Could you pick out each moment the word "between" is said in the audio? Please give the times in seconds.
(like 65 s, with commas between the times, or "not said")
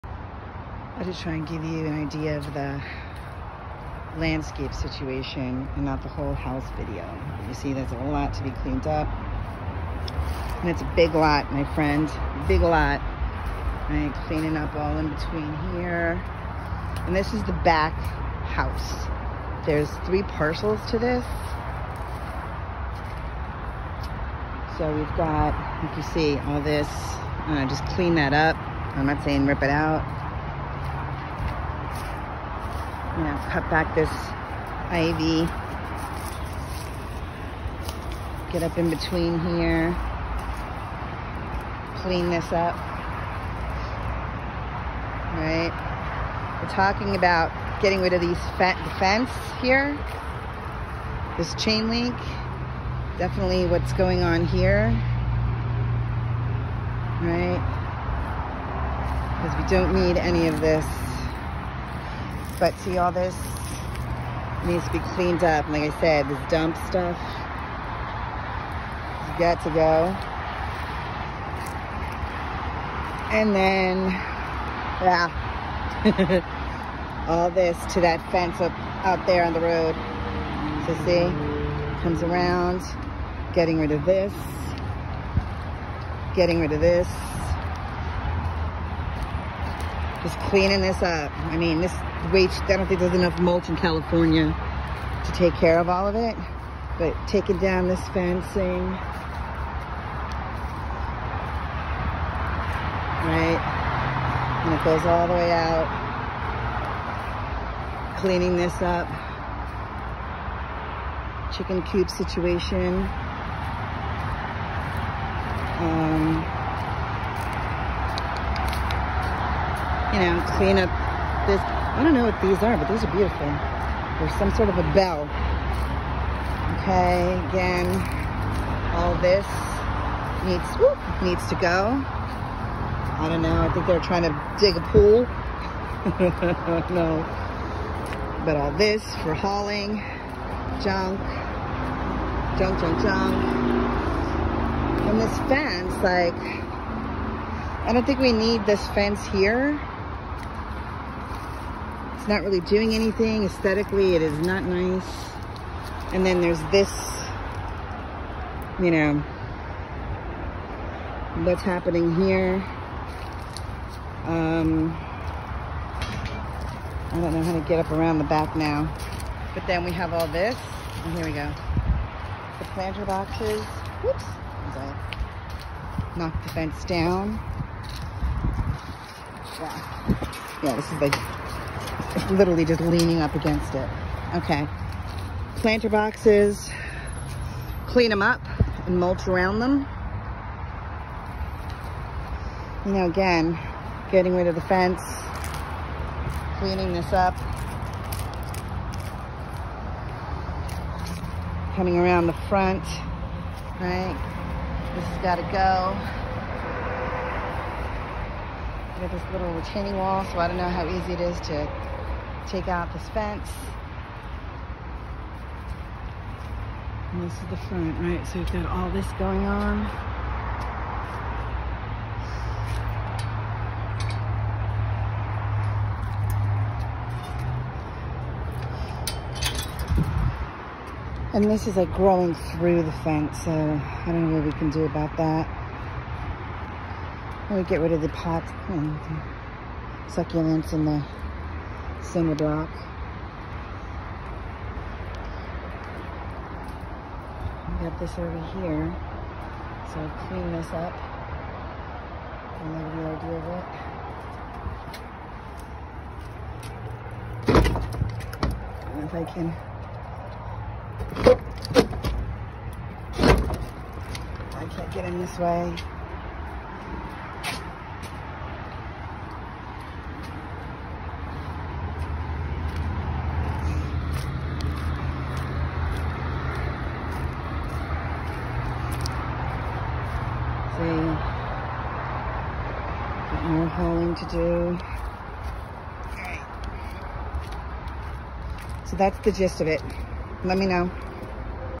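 15 s, 38 s.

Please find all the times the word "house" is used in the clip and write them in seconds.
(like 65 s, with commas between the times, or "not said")
6 s, 18 s.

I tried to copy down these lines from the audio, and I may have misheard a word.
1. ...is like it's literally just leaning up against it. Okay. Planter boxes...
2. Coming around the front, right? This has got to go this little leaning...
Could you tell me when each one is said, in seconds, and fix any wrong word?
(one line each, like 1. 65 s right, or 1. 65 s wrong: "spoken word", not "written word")
1. 180 s right
2. 201 s wrong: "retaining", not "leaning".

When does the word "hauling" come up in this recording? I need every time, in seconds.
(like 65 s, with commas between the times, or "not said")
139 s, 283 s.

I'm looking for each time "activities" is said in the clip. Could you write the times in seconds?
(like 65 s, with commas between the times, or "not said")
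not said.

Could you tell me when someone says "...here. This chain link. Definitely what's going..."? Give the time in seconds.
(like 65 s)
49 s.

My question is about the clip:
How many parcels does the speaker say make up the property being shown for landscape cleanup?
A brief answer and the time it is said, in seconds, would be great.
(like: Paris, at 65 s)
3, at 20 s.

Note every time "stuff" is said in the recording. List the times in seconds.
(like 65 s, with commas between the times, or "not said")
66 s.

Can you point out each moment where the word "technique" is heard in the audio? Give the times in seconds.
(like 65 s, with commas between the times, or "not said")
not said.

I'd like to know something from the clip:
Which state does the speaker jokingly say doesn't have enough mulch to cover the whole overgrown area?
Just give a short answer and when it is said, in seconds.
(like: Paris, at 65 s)
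California, at 93 s.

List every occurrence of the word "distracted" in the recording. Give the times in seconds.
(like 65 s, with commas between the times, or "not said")
not said.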